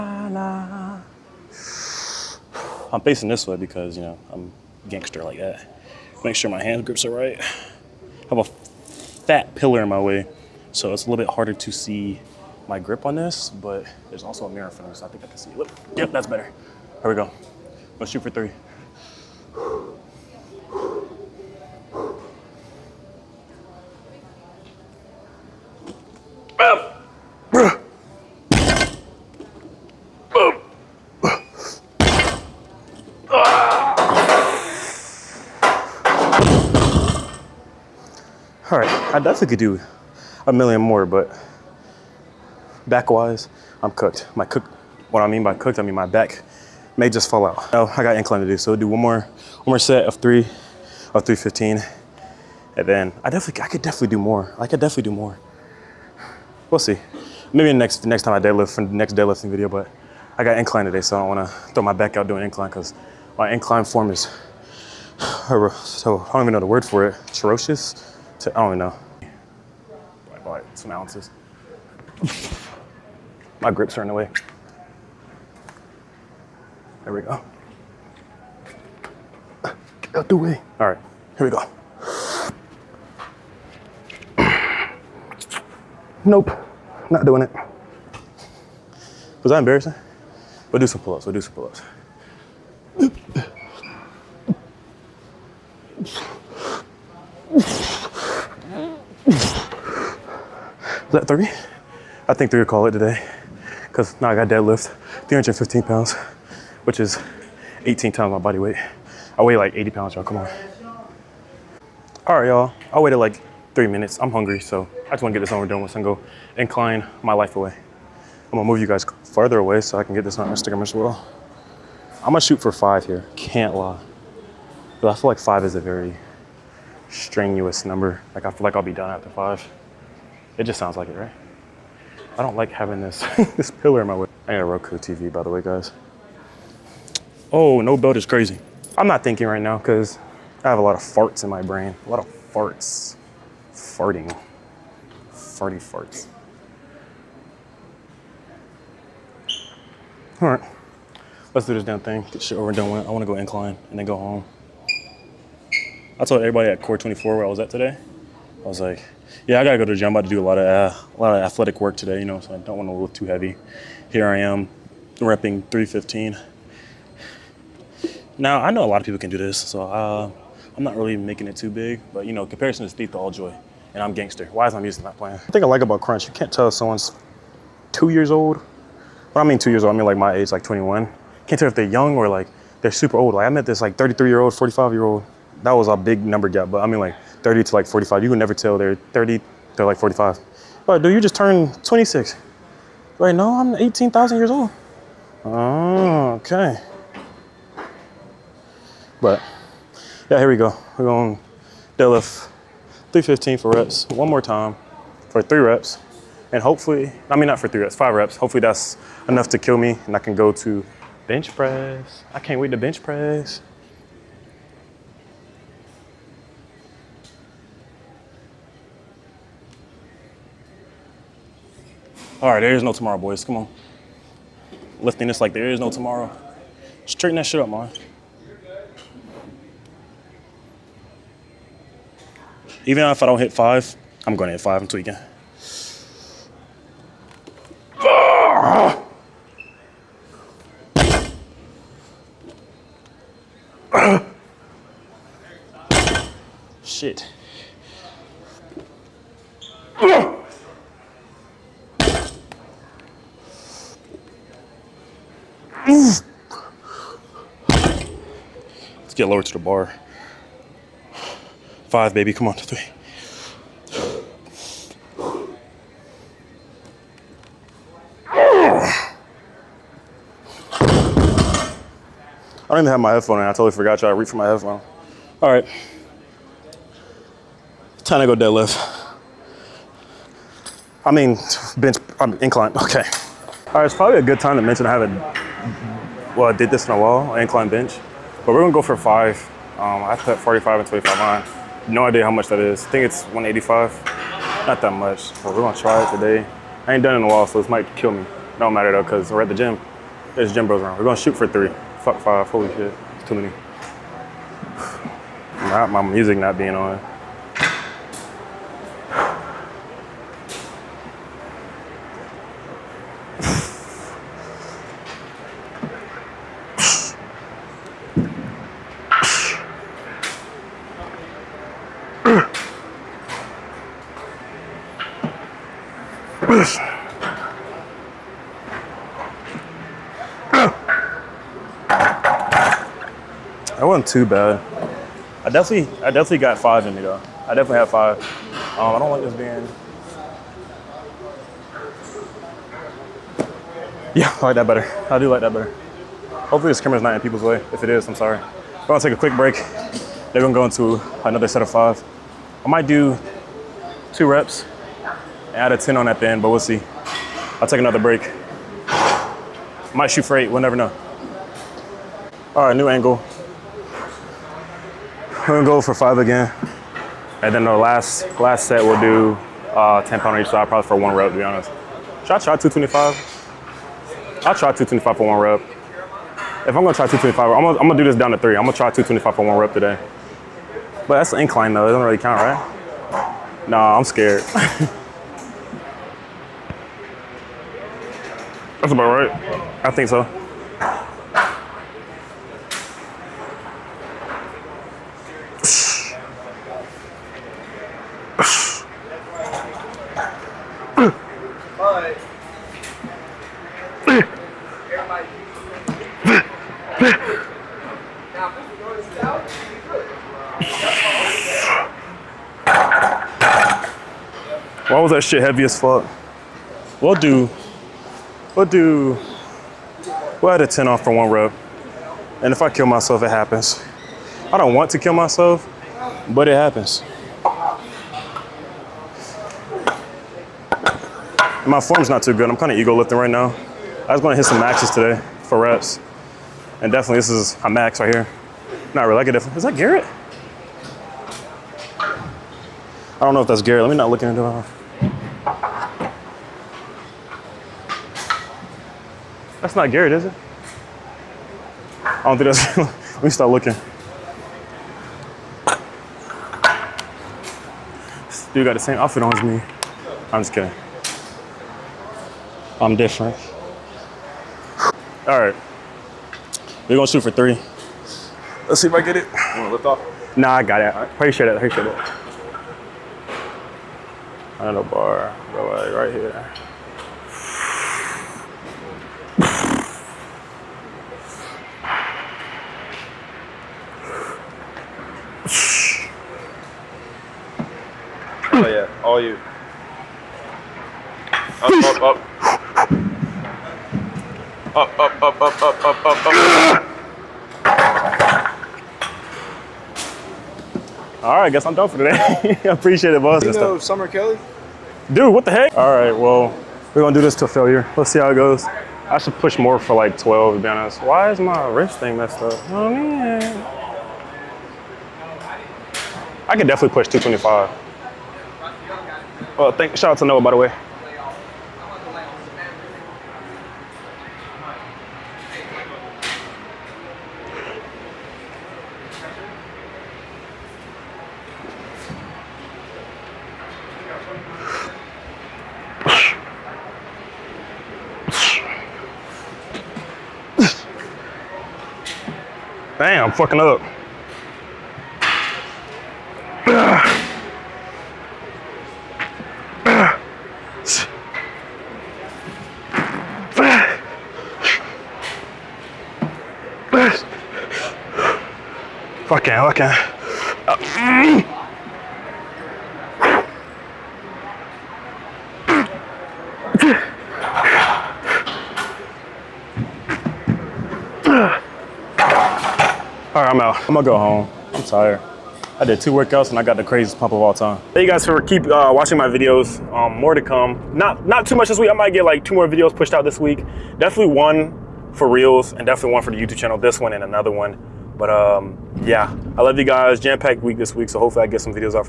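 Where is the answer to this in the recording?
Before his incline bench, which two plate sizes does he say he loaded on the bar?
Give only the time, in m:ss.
4:50.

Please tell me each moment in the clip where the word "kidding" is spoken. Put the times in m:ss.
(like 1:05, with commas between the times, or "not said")
7:40.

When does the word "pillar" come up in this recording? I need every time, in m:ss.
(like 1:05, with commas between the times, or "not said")
0:09, 2:13.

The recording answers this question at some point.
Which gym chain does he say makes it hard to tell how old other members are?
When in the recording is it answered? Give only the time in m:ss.
2:56.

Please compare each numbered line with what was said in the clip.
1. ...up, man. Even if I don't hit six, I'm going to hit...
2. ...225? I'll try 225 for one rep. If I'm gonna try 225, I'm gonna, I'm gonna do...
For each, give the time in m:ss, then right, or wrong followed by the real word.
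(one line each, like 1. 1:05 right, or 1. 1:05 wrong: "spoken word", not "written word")
1. 3:47 wrong: "five", not "six"
2. 6:12 right.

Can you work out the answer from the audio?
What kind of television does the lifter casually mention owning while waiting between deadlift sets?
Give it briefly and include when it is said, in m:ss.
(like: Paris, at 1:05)
Roku TV, at 2:14.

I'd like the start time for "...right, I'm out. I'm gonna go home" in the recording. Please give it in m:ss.
9:33.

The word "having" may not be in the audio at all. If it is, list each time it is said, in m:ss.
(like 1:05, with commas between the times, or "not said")
2:12.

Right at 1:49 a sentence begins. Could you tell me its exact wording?
I weigh like 80 pounds, y'all, come on.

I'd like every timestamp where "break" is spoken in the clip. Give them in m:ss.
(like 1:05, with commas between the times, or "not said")
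5:49, 5:57.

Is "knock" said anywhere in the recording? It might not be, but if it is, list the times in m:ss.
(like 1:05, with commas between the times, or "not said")
not said.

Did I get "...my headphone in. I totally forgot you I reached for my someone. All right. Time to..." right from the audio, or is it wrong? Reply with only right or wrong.
wrong.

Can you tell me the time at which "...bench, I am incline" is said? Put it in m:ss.
4:41.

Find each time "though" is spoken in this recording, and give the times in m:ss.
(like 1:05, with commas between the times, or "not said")
4:58, 5:37, 6:21.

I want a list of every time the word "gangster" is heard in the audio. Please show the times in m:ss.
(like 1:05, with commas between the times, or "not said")
0:04, 2:54.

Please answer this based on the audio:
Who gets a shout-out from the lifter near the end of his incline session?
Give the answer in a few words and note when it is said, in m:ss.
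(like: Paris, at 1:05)
Noah, at 8:40.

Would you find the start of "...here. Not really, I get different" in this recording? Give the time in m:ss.
7:18.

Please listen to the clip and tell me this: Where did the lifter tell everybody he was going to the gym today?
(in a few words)
Core 24.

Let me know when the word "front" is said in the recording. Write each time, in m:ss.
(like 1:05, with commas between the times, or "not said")
0:14.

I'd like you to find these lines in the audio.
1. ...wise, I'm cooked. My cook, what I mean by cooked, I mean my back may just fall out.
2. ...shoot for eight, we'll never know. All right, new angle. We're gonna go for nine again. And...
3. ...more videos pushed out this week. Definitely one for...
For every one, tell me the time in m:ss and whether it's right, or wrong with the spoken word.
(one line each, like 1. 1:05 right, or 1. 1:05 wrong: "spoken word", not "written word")
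1. 0:43 right
2. 6:00 wrong: "five", not "nine"
3. 9:42 right.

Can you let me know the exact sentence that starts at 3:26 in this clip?
And hopefully, I mean, not for three reps, five reps.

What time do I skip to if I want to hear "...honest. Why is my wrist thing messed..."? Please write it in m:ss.
8:30.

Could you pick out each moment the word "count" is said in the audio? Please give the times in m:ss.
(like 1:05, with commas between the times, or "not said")
6:22.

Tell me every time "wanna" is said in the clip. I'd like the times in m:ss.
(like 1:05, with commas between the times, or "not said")
1:01, 1:55, 7:49.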